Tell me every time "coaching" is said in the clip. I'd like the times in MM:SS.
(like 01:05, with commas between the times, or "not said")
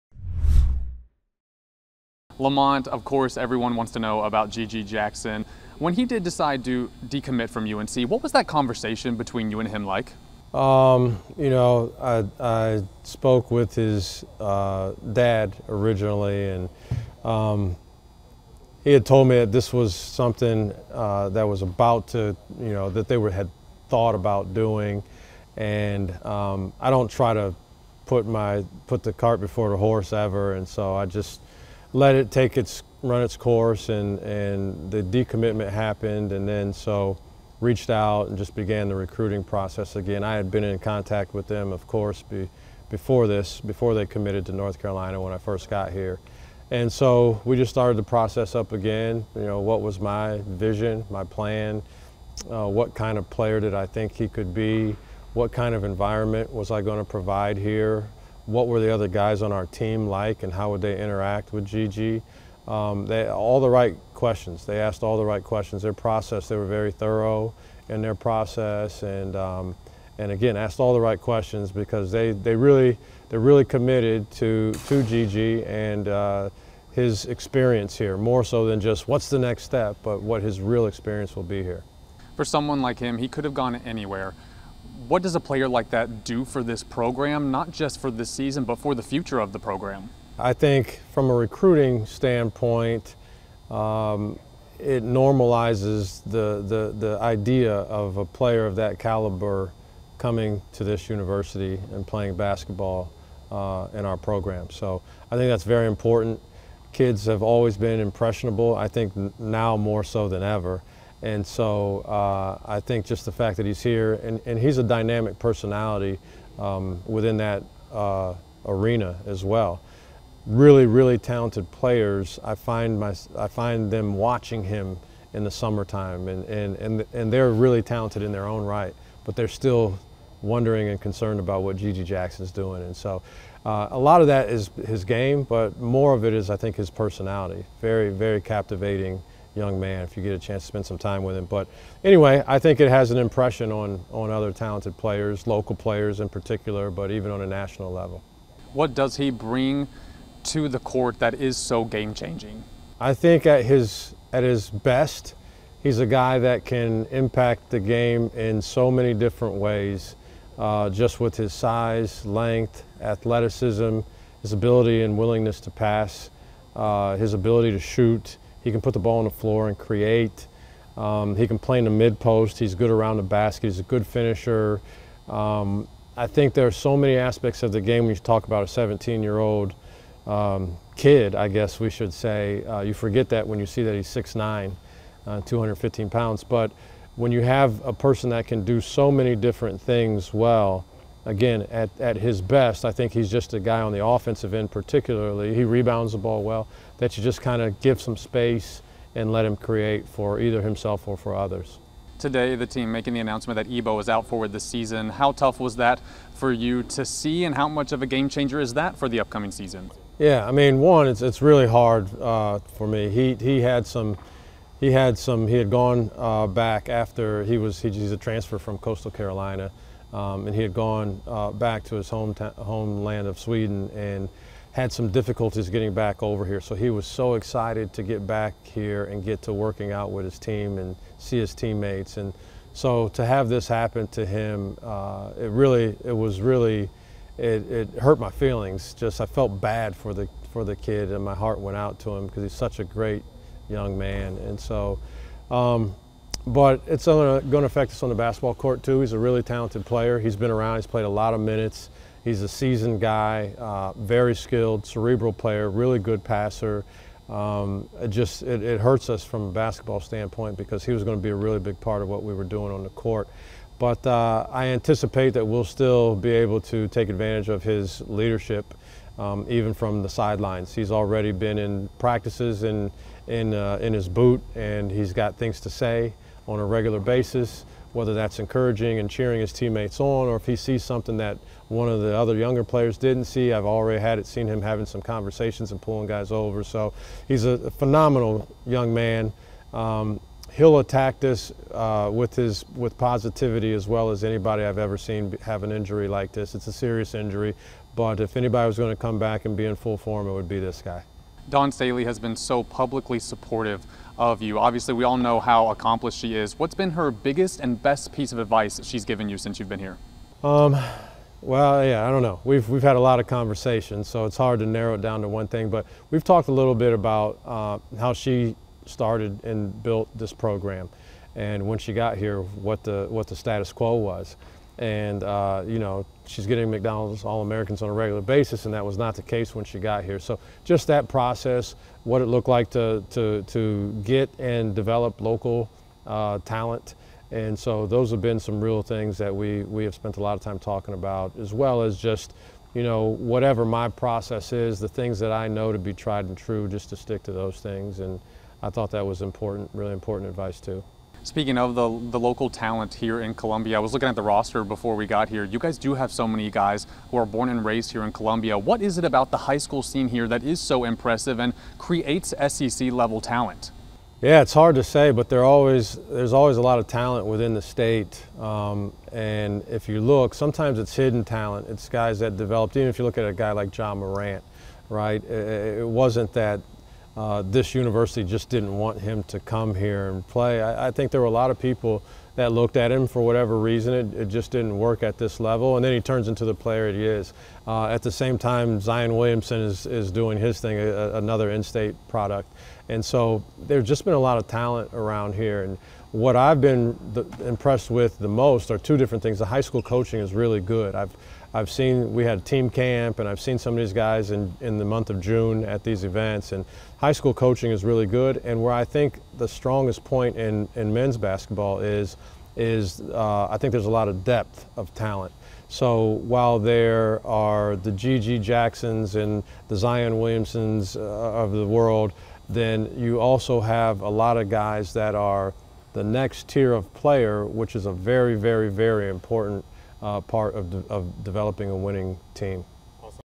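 06:39, 06:47.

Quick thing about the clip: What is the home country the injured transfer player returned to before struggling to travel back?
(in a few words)
Sweden.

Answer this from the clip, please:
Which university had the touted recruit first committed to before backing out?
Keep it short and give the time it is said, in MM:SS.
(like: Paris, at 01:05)
North Carolina, at 00:44.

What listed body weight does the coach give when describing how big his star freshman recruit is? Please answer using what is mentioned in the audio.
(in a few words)
215 pounds.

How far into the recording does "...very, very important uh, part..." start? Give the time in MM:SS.
07:08.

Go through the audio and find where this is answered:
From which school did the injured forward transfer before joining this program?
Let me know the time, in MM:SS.
03:38.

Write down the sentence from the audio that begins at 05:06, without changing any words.
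What's been her biggest and best piece of advice that she's given you since you've been here?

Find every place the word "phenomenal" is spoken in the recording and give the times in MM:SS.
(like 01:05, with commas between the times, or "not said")
04:47.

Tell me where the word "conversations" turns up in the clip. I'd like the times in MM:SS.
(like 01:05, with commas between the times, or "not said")
00:08, 04:45, 05:13.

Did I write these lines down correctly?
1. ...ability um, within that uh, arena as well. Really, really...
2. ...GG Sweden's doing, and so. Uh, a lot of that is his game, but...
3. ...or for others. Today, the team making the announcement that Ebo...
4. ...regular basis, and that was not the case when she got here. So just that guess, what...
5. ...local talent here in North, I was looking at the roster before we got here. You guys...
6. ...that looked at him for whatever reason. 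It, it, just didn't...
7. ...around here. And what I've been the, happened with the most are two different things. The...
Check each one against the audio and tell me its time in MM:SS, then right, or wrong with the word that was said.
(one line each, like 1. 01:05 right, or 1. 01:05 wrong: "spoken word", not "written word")
1. 01:55 wrong: "personality", not "ability"
2. 02:11 wrong: "Jackson", not "Sweden"
3. 03:21 right
4. 05:27 wrong: "process", not "guess"
5. 05:52 wrong: "Columbia", not "North"
6. 06:22 right
7. 06:34 wrong: "impressed", not "happened".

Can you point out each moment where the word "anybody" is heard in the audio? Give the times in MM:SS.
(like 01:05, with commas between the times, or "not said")
04:54, 04:58.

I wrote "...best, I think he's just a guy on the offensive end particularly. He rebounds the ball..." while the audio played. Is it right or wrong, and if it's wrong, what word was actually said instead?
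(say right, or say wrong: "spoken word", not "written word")
right.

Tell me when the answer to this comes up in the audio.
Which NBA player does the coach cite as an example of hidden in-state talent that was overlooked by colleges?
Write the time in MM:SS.
06:13.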